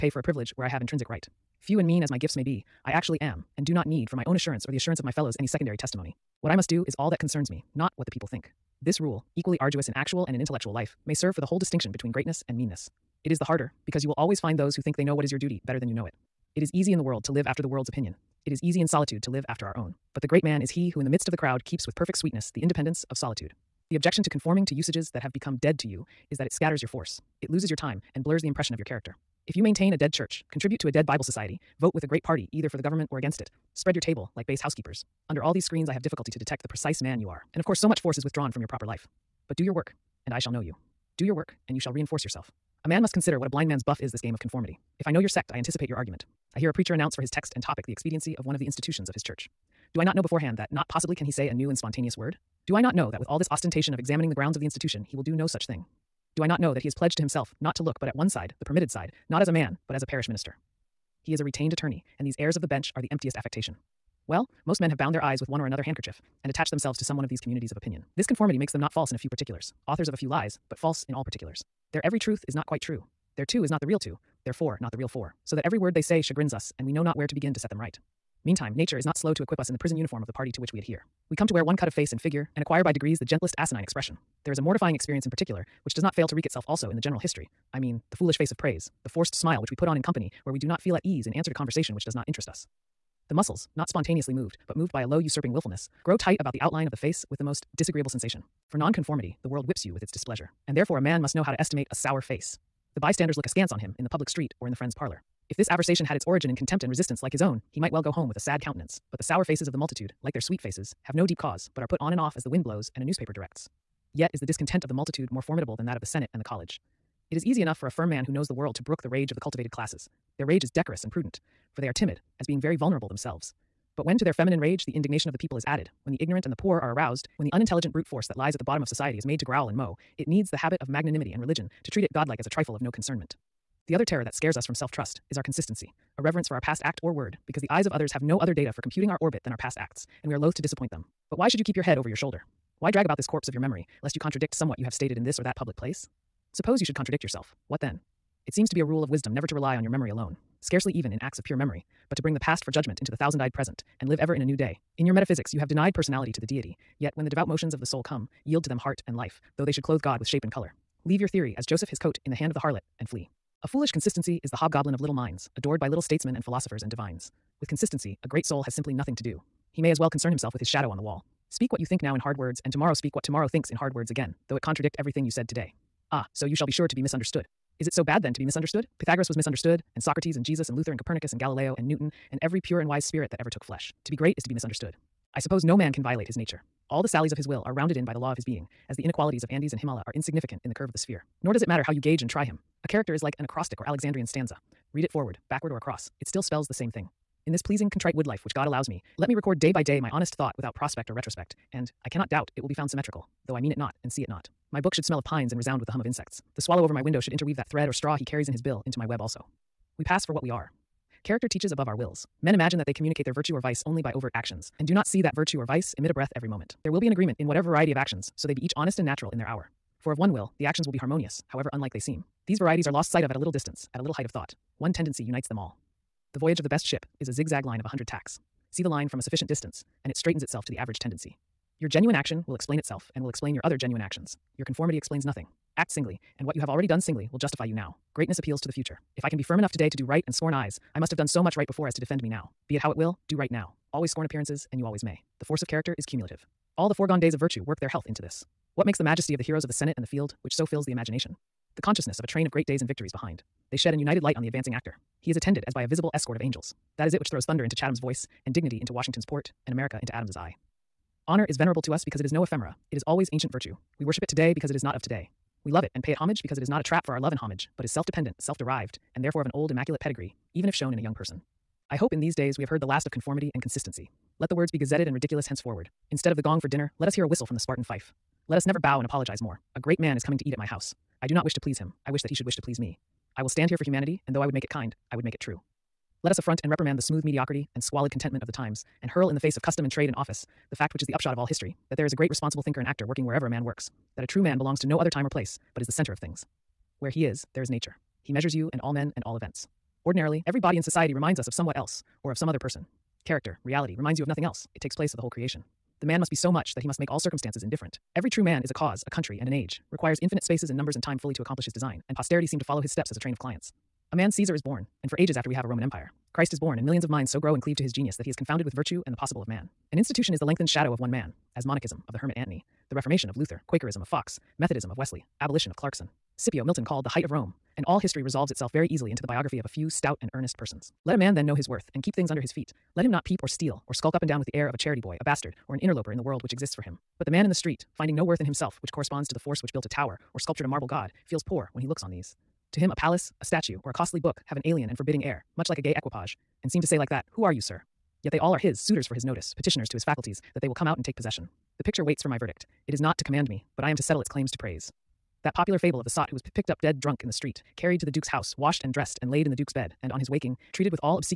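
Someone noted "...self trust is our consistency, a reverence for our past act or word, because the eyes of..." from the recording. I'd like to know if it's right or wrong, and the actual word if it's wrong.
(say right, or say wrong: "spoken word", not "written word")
right.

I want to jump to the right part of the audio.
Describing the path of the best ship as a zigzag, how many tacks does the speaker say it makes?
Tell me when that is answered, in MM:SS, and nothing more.
03:47.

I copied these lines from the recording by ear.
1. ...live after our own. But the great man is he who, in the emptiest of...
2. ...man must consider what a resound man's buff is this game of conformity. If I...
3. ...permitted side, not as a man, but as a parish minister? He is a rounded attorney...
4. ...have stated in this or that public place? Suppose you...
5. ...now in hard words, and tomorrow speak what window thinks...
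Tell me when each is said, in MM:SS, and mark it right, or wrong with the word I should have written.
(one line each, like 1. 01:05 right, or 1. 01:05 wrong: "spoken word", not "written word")
1. 00:19 wrong: "midst", not "emptiest"
2. 00:42 wrong: "blind", not "resound"
3. 00:58 wrong: "retained", not "rounded"
4. 02:24 right
5. 02:52 wrong: "tomorrow", not "window".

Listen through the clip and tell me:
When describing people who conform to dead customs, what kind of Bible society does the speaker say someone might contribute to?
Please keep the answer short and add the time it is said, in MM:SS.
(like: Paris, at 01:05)
a dead Bible society, at 00:30.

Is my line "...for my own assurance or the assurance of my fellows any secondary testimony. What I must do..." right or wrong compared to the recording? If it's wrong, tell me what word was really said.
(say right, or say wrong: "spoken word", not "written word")
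right.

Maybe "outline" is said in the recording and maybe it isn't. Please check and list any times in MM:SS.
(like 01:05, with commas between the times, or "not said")
01:36.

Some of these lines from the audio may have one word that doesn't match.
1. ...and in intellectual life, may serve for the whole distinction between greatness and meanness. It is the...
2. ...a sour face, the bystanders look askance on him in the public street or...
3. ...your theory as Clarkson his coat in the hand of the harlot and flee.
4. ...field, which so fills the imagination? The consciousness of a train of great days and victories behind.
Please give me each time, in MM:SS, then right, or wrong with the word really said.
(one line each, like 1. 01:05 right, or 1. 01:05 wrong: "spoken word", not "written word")
1. 00:10 right
2. 01:41 right
3. 02:41 wrong: "Joseph", not "Clarkson"
4. 04:10 right.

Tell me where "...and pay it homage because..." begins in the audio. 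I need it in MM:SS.
04:25.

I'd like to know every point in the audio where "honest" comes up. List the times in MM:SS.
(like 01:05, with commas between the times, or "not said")
03:20, 03:38.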